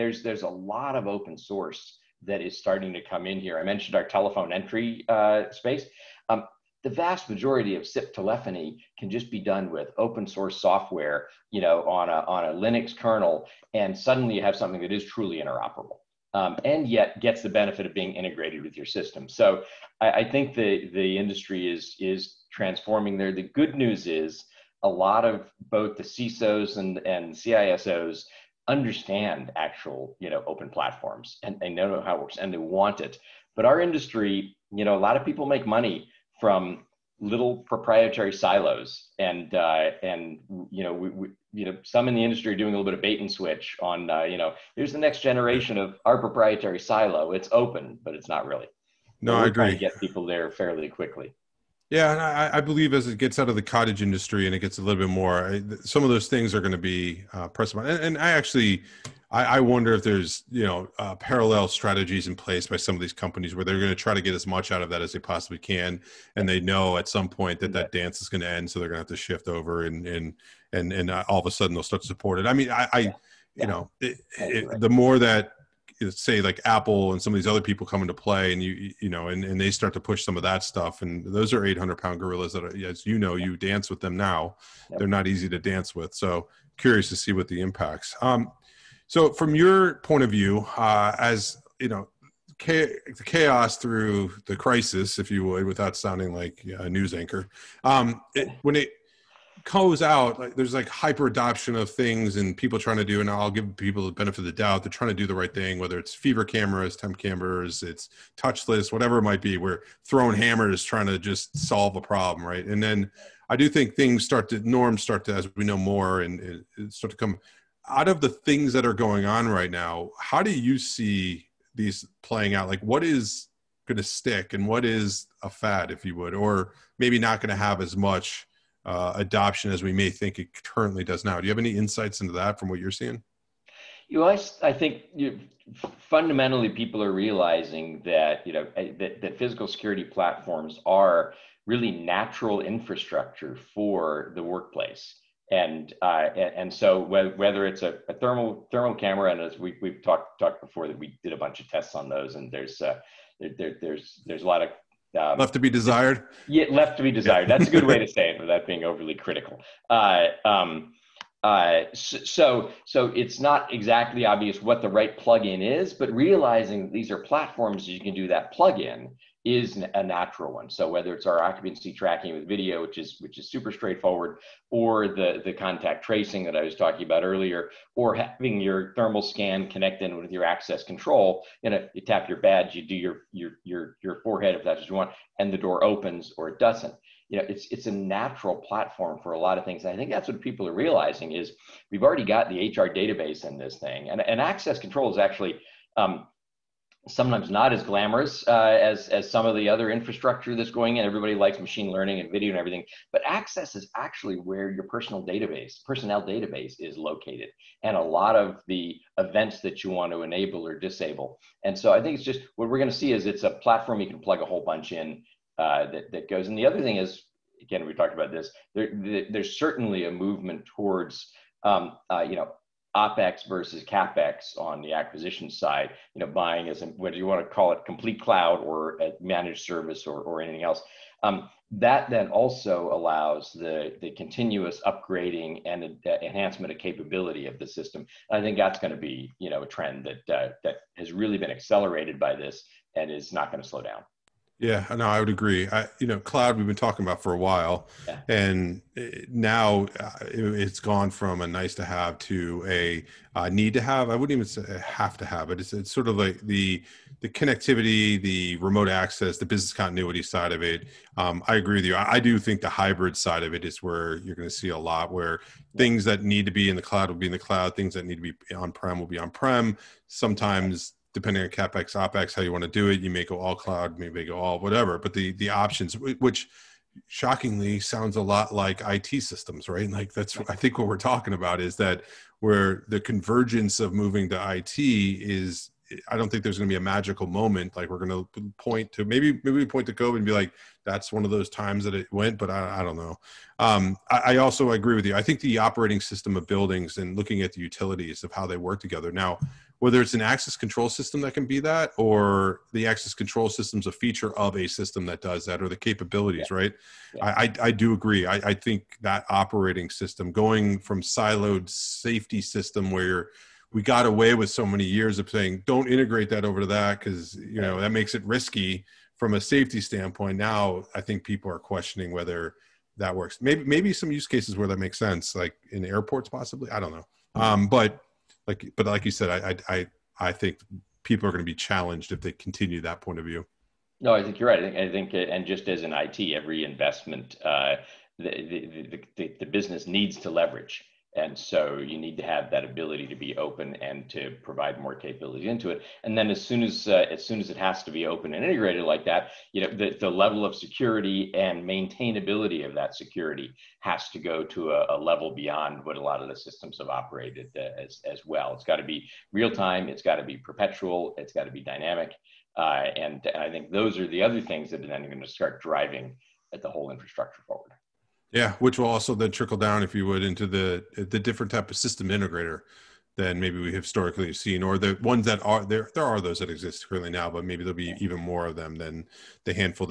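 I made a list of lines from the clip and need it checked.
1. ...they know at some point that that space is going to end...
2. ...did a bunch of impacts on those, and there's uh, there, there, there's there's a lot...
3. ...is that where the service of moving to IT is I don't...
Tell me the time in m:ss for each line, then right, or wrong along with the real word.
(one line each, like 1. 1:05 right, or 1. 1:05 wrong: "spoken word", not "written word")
1. 1:06 wrong: "dance", not "space"
2. 2:31 wrong: "tests", not "impacts"
3. 4:41 wrong: "convergence", not "service".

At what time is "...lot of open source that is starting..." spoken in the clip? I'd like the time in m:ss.
0:00.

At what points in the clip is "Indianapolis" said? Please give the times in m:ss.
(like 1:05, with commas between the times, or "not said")
not said.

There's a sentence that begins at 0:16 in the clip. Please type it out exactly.
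Um, and yet gets the benefit of being integrated with your system.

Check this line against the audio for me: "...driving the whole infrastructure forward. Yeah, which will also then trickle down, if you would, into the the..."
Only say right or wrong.
right.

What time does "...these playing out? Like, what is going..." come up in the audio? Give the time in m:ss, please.
2:01.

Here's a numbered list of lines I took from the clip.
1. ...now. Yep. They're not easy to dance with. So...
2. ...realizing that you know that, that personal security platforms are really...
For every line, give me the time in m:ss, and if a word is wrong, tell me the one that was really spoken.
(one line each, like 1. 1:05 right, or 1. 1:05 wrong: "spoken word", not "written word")
1. 1:24 right
2. 2:17 wrong: "physical", not "personal".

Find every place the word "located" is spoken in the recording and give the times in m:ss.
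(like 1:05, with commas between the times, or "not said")
3:26.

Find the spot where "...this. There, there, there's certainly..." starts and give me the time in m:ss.
3:38.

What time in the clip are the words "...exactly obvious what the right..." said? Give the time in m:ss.
2:43.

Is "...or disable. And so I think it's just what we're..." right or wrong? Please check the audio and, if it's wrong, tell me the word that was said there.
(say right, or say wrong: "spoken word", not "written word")
right.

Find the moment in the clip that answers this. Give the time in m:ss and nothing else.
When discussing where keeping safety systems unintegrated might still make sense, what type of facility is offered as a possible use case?
5:25.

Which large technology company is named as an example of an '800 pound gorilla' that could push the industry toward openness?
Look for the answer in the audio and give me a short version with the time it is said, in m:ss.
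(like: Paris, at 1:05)
Apple, at 1:16.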